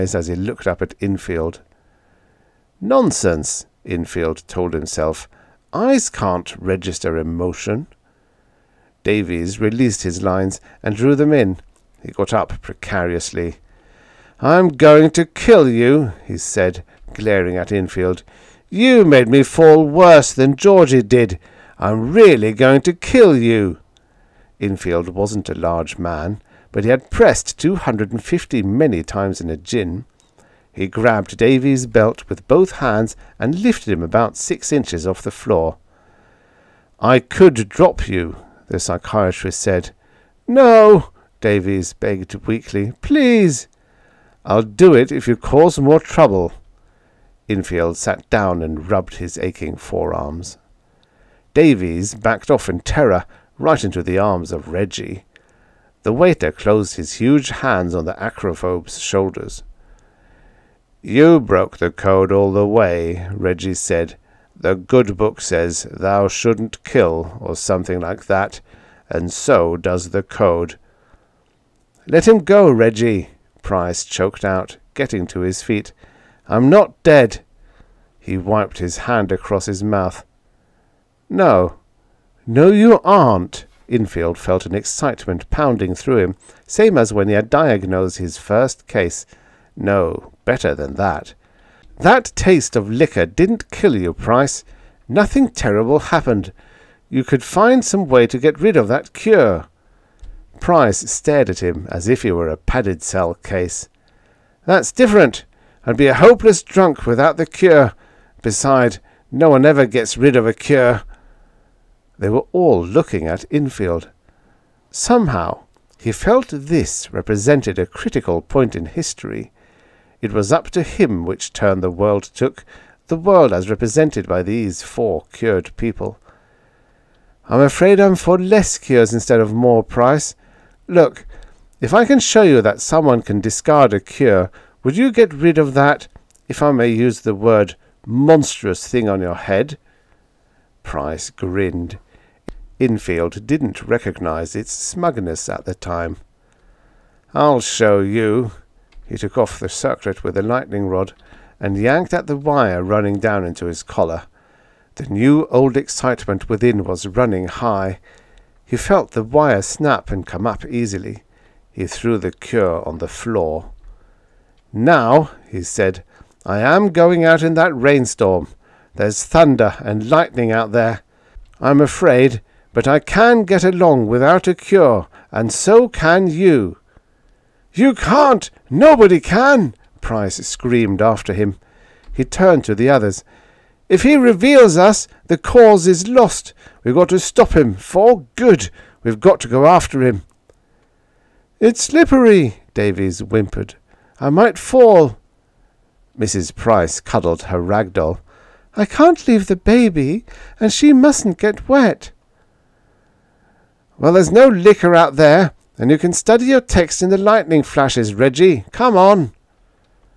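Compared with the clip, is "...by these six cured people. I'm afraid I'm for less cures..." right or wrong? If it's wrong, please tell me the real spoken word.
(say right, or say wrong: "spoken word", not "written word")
wrong: "four", not "six".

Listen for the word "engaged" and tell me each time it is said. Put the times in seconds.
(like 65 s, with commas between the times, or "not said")
not said.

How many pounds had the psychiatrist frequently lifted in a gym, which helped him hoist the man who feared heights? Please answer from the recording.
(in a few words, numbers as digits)
250.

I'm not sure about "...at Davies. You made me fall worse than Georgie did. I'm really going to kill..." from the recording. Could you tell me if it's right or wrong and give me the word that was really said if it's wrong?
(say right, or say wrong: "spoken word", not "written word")
wrong: "Infield", not "Davies".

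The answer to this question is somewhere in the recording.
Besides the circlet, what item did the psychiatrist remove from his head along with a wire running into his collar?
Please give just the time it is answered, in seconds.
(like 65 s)
150 s.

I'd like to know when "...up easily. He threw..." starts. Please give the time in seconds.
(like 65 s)
160 s.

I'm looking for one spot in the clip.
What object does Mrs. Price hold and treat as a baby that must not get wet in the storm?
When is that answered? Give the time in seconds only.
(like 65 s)
197 s.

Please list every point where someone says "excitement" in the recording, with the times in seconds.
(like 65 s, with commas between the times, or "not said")
84 s, 155 s.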